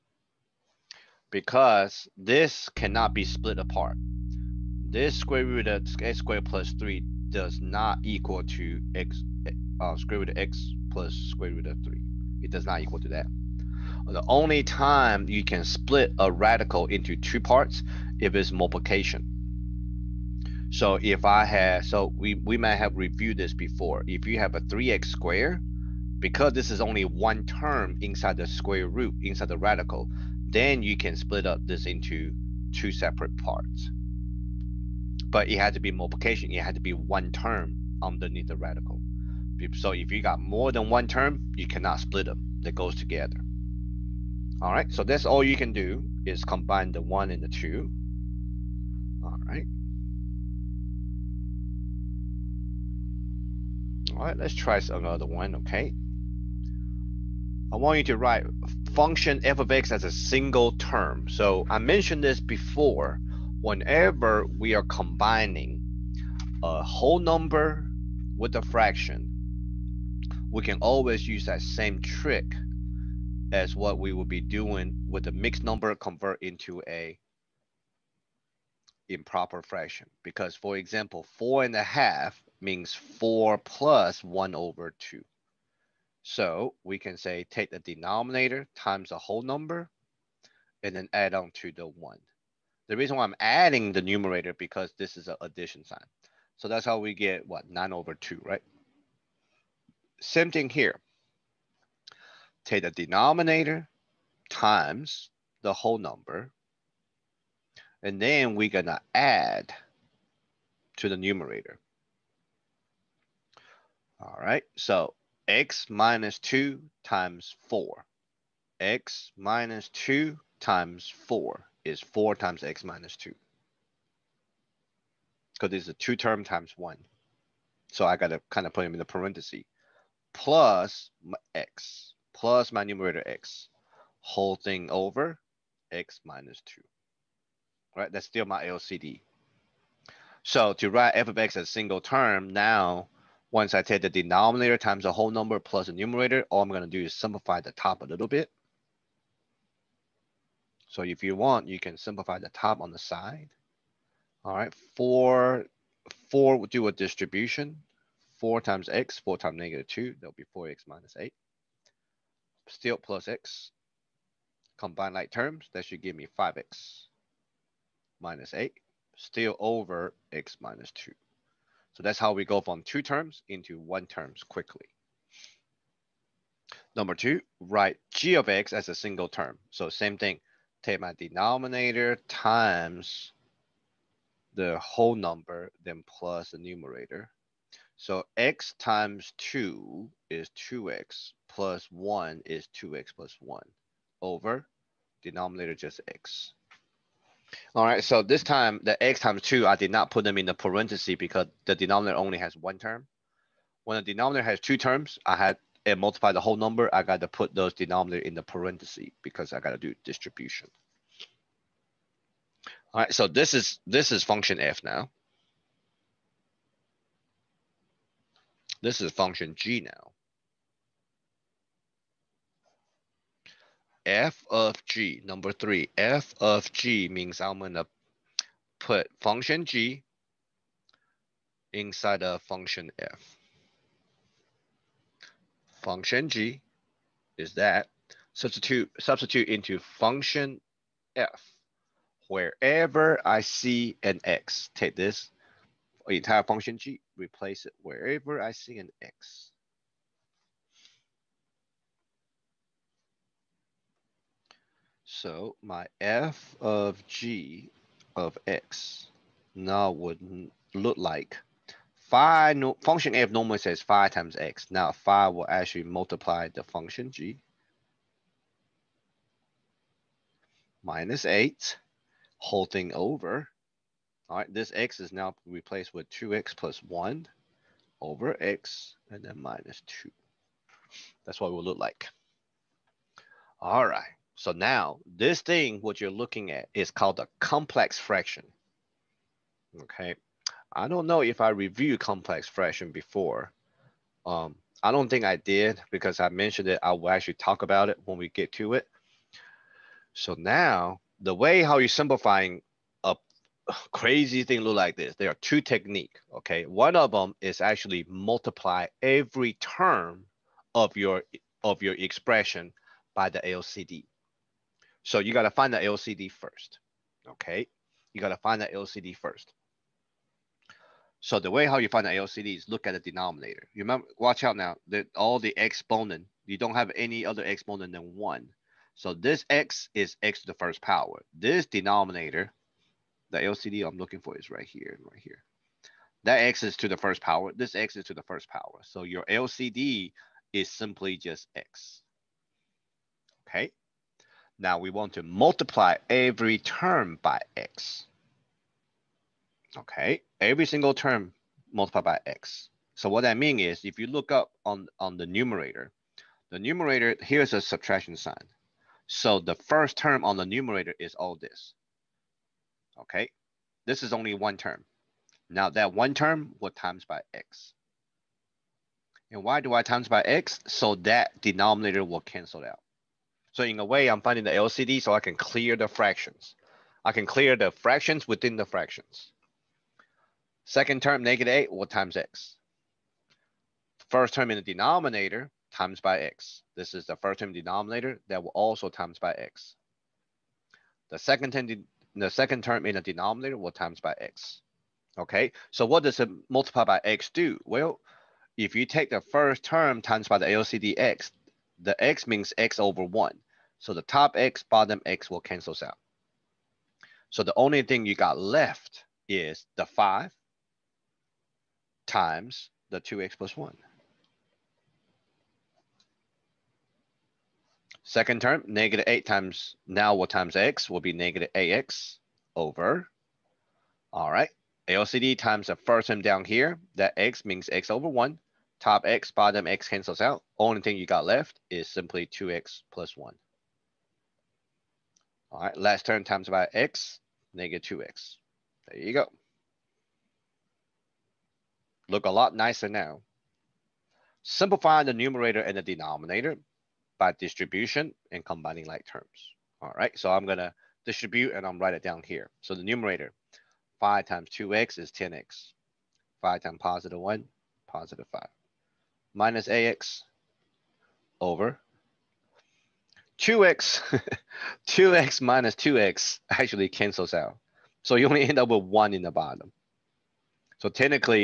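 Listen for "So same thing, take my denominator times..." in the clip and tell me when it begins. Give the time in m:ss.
2:59.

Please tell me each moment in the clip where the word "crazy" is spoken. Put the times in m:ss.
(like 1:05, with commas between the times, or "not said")
5:03.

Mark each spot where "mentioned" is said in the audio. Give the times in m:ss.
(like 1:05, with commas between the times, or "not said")
1:01, 4:56.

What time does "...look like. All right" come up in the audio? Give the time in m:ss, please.
4:41.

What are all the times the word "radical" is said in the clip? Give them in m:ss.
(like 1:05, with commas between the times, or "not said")
0:16, 0:29, 0:38.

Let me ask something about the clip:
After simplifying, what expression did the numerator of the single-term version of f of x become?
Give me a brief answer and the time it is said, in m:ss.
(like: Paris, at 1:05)
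5x - 8, at 2:46.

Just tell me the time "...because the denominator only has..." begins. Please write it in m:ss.
3:21.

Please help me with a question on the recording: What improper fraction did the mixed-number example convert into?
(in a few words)
9/2.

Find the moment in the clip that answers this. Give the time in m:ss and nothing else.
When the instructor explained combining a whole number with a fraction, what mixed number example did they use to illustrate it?
1:21.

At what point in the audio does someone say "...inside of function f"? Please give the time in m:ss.
3:51.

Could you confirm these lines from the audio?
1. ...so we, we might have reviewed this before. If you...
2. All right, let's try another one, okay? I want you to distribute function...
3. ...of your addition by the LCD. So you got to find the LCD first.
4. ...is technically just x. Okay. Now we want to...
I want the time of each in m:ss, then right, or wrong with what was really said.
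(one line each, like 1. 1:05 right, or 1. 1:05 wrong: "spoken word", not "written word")
1. 0:21 right
2. 0:54 wrong: "write", not "distribute"
3. 5:11 wrong: "expression", not "addition"
4. 5:40 wrong: "simply", not "technically".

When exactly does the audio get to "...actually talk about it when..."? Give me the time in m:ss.
4:57.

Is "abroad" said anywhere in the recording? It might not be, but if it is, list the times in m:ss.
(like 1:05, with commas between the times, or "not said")
not said.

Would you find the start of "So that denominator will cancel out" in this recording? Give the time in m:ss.
6:10.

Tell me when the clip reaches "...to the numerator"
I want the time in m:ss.
1:50.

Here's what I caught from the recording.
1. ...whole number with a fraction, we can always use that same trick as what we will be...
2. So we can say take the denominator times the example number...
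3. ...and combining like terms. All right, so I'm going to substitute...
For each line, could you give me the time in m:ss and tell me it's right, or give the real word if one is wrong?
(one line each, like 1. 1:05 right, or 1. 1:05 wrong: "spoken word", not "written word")
1. 1:06 right
2. 1:26 wrong: "whole", not "example"
3. 7:28 wrong: "distribute", not "substitute".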